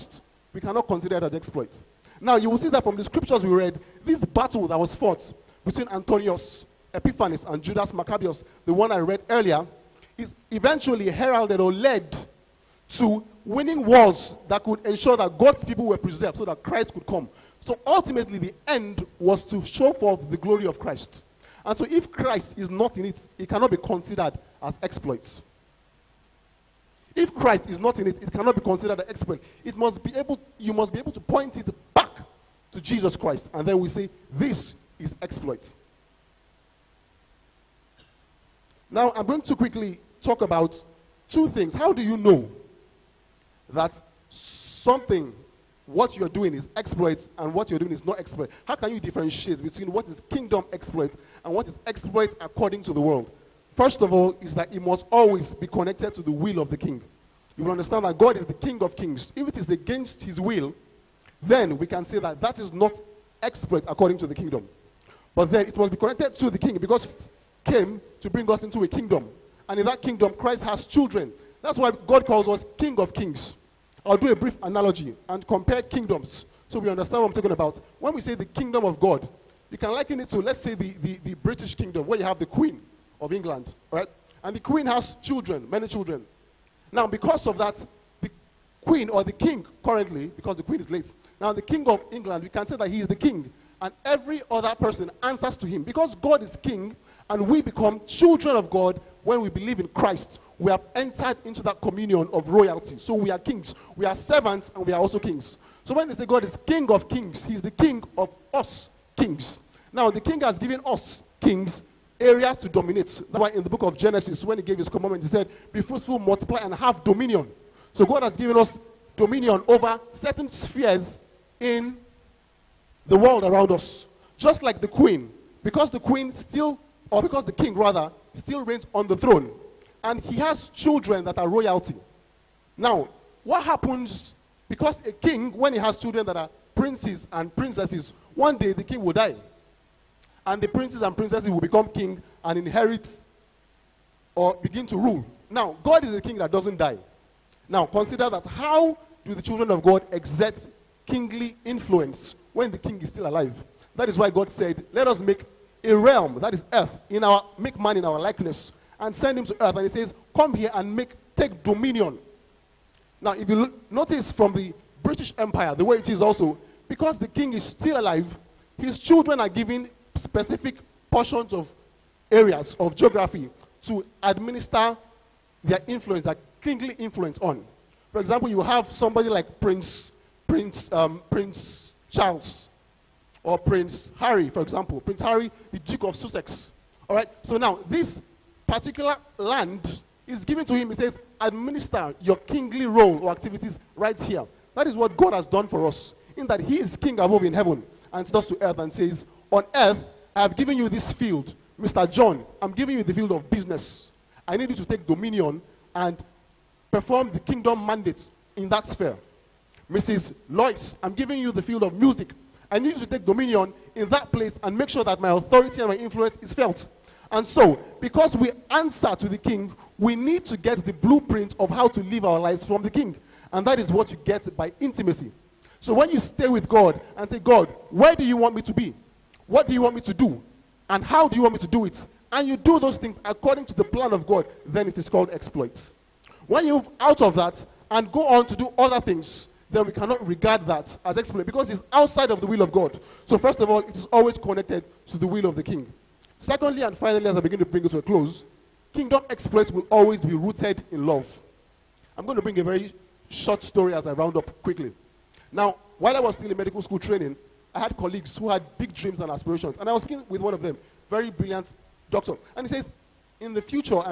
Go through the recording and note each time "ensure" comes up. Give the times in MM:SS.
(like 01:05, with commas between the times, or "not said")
00:14.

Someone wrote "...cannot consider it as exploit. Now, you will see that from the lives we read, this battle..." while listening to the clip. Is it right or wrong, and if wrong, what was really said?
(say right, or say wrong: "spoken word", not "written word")
wrong: "scriptures", not "lives".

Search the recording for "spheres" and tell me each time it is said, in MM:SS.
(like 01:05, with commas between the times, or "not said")
02:00, 03:28.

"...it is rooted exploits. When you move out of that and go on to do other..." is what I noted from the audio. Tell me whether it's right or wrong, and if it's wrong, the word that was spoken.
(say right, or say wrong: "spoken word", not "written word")
wrong: "called", not "rooted".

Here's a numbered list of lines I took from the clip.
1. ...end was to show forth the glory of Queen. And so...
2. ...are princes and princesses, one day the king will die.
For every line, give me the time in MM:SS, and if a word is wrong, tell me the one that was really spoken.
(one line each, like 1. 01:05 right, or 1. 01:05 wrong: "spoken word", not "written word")
1. 00:18 wrong: "Christ", not "Queen"
2. 02:16 right.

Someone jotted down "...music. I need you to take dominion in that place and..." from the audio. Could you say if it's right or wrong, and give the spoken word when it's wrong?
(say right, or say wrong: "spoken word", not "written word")
right.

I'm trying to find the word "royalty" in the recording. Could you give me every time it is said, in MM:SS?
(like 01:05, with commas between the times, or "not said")
01:42, 02:11.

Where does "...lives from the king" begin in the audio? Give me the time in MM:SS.
03:42.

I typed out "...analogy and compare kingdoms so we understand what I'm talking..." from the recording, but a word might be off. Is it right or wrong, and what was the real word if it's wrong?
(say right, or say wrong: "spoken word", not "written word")
right.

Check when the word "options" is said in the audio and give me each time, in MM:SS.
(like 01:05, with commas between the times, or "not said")
not said.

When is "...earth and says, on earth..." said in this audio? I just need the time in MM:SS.
03:18.